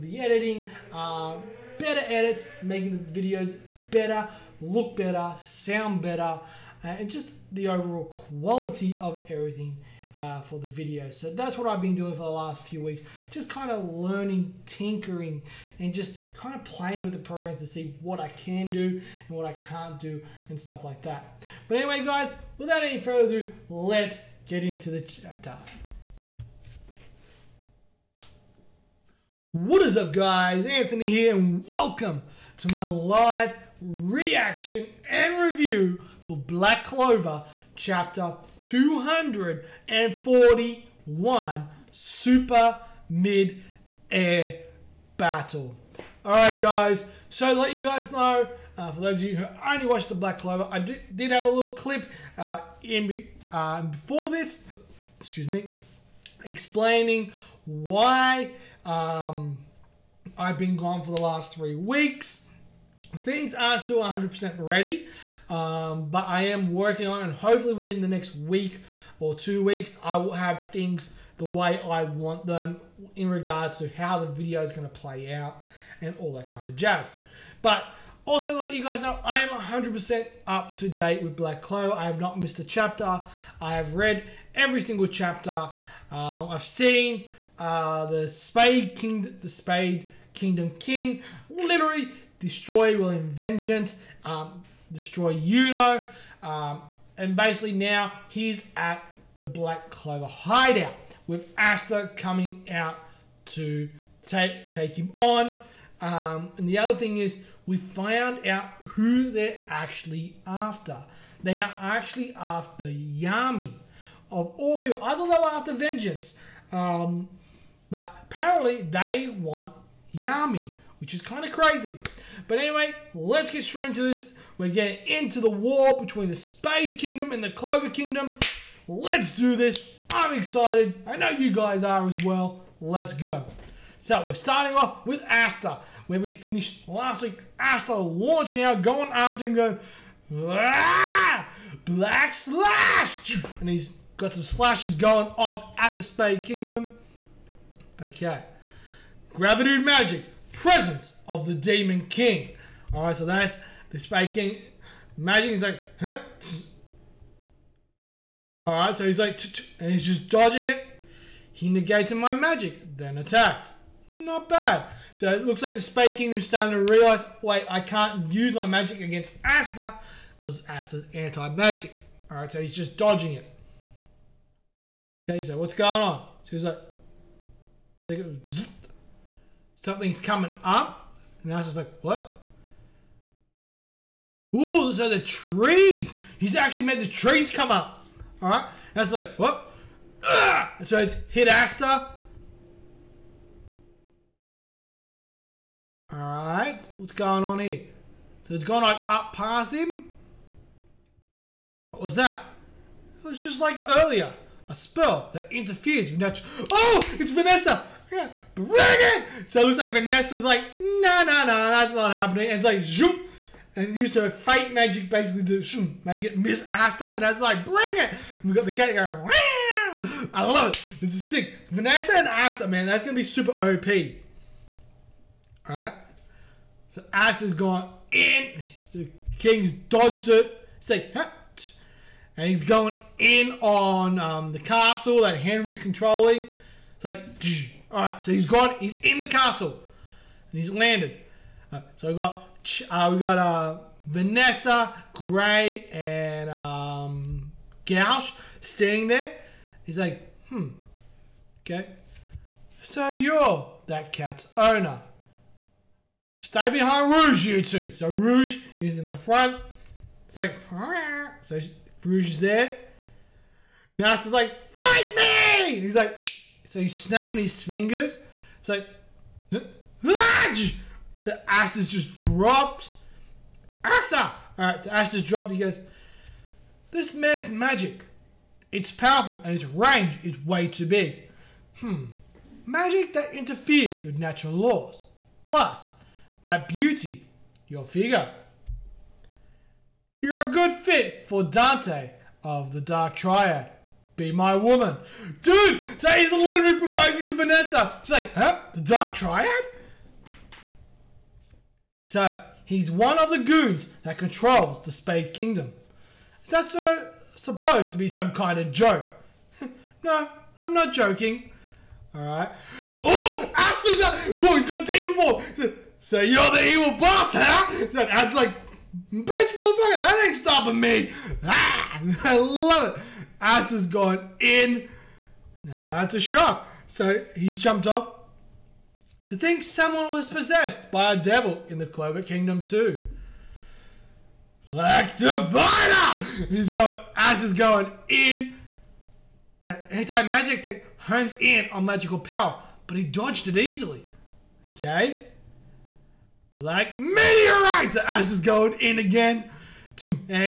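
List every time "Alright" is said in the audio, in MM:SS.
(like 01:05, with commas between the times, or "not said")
04:34, 05:12.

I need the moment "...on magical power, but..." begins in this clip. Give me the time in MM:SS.
05:41.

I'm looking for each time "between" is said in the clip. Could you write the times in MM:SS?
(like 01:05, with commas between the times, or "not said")
02:06.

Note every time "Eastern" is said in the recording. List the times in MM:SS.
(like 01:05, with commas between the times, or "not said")
not said.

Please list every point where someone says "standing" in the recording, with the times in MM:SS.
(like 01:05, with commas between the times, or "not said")
04:08.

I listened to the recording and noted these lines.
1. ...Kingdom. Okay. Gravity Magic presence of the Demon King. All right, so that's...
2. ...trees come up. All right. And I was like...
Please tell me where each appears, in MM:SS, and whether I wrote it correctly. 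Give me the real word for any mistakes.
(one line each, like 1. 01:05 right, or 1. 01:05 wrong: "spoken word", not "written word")
1. 02:26 right
2. 03:07 right.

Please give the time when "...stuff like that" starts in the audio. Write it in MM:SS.
00:20.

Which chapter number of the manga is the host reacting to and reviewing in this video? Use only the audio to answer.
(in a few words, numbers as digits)
241.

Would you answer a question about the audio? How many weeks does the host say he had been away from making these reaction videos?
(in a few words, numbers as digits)
3.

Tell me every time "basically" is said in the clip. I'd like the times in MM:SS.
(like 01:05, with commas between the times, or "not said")
01:37, 03:35.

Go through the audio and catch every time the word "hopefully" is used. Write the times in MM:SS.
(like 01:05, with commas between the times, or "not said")
01:07.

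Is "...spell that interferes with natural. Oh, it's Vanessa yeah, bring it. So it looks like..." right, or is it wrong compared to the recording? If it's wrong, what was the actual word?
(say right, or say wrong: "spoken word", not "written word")
right.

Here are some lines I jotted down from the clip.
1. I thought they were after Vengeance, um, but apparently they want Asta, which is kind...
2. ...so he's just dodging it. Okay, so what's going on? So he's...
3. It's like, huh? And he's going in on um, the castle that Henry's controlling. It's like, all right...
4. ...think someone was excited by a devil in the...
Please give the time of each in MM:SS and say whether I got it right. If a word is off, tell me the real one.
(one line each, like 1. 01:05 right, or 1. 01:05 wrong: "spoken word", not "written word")
1. 01:55 wrong: "Yami", not "Asta"
2. 02:52 right
3. 03:50 right
4. 05:29 wrong: "possessed", not "excited".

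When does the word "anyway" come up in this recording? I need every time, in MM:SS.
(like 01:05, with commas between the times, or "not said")
00:21, 02:02.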